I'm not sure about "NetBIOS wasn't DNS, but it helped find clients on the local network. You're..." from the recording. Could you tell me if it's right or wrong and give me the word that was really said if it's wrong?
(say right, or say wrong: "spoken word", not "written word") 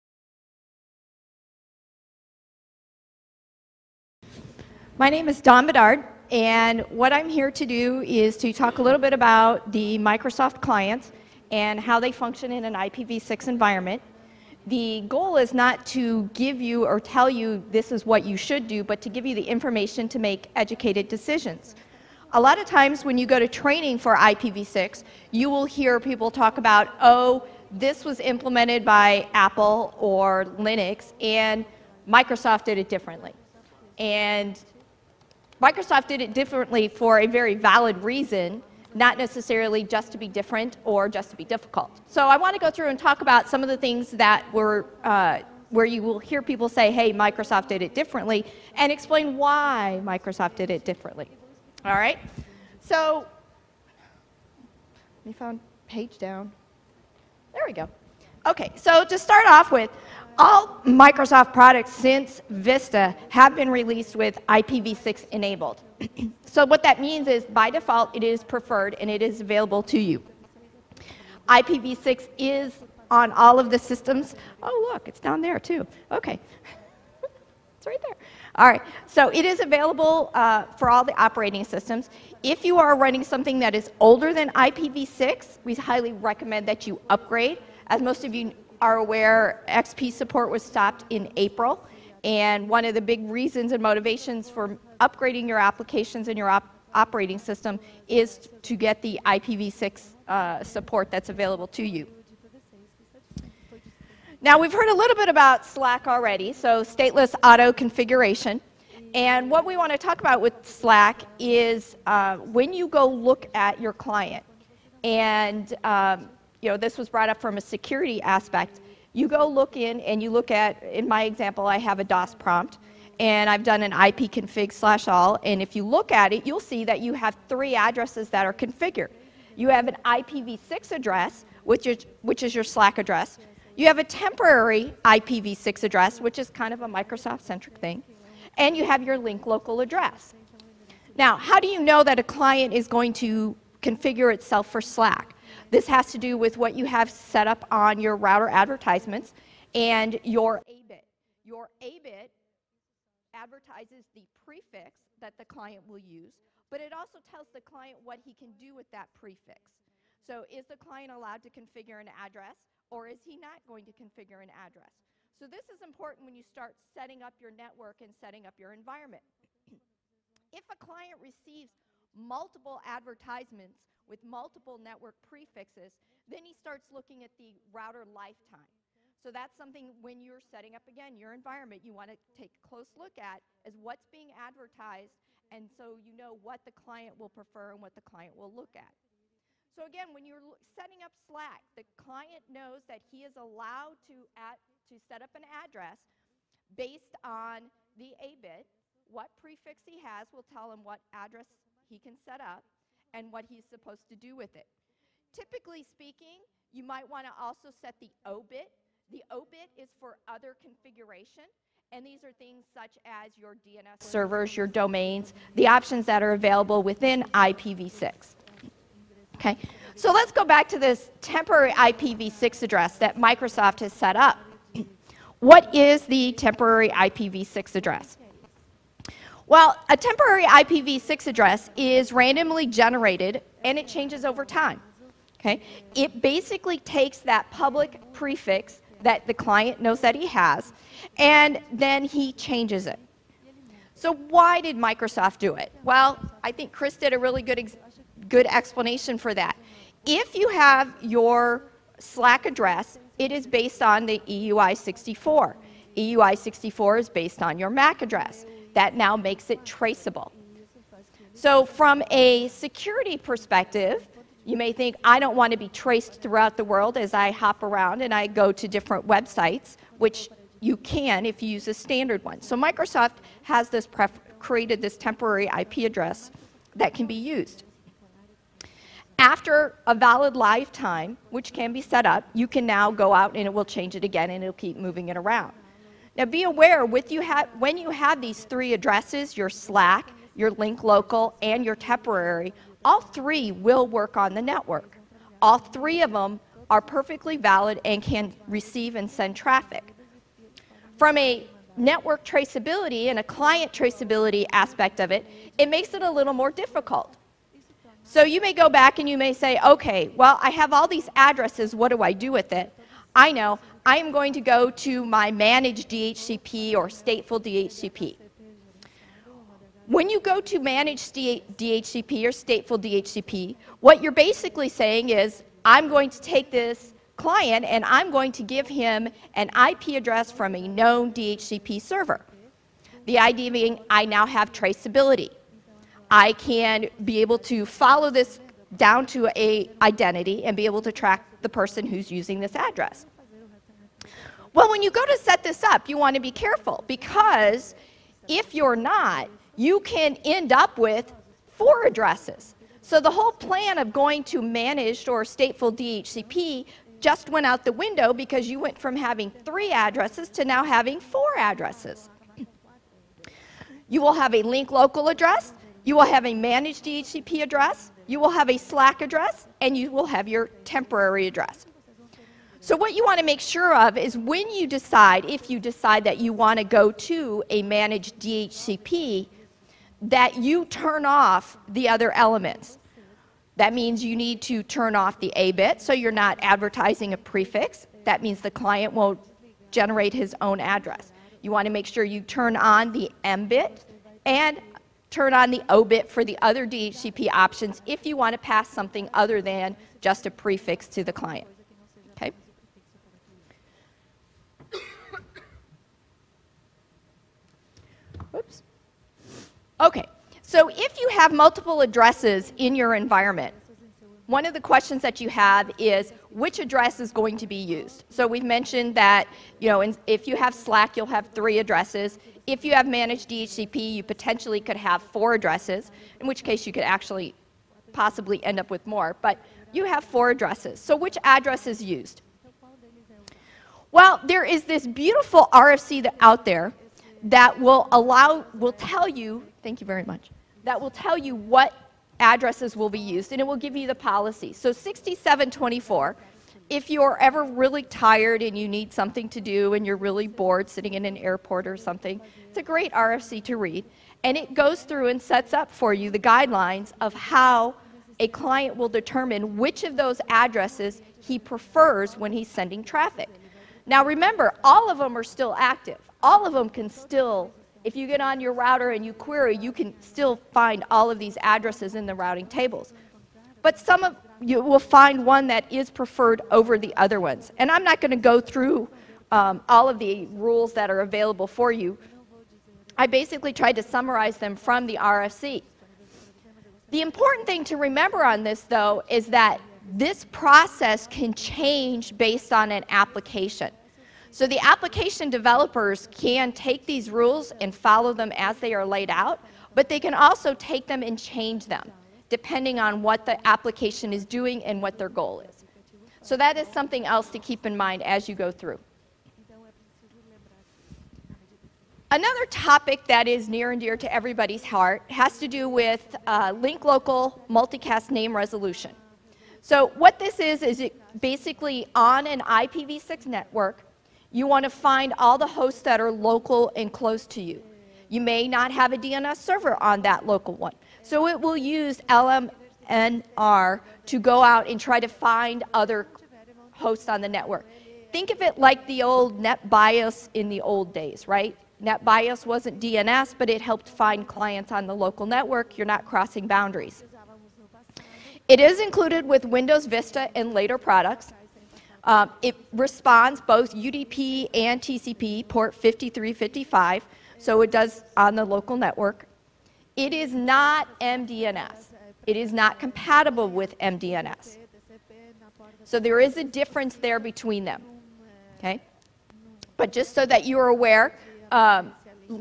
right.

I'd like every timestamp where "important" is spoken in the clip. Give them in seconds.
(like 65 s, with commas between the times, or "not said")
165 s, 487 s.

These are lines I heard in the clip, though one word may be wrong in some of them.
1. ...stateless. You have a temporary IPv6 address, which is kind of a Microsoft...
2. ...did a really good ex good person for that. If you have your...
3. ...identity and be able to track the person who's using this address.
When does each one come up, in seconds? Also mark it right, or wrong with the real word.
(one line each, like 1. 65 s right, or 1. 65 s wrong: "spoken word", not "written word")
1. 132 s wrong: "address", not "stateless"
2. 246 s wrong: "explanation", not "person"
3. 339 s right.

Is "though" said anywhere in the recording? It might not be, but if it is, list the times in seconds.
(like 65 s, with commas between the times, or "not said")
488 s.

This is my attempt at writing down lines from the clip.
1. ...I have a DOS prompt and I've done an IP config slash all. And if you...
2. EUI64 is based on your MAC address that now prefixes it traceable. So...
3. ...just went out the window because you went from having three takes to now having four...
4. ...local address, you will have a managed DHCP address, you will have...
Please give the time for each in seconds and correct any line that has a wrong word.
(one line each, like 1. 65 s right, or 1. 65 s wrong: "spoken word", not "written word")
1. 121 s right
2. 255 s wrong: "makes", not "prefixes"
3. 357 s wrong: "addresses", not "takes"
4. 364 s right.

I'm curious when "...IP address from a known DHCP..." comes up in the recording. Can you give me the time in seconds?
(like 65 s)
329 s.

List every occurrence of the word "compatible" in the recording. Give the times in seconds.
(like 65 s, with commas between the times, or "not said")
562 s.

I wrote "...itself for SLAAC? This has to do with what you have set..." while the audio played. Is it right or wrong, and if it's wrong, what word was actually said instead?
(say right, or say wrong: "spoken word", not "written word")
right.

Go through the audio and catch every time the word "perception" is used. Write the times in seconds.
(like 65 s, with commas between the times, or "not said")
not said.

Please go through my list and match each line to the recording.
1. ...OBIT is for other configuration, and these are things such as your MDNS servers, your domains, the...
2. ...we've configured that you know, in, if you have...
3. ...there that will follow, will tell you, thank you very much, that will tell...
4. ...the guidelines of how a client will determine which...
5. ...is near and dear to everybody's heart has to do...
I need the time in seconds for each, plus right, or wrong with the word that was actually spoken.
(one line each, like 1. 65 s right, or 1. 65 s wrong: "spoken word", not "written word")
1. 209 s wrong: "DNS", not "MDNS"
2. 418 s wrong: "mentioned", not "configured"
3. 436 s wrong: "allow", not "follow"
4. 456 s right
5. 513 s right.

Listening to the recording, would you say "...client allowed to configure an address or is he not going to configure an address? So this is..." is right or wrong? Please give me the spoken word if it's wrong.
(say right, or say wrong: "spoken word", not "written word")
right.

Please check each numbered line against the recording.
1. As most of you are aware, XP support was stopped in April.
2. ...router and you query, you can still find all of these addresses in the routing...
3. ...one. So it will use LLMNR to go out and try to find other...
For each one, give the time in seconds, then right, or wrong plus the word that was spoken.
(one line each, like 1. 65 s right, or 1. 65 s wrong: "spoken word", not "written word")
1. 87 s right
2. 468 s right
3. 530 s right.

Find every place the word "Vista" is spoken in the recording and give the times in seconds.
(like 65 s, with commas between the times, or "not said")
62 s, 549 s.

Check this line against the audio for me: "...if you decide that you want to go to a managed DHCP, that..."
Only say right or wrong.
right.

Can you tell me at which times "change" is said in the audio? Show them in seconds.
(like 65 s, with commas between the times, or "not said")
233 s, 242 s, 283 s, 491 s, 501 s.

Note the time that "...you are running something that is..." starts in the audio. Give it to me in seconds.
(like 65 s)
82 s.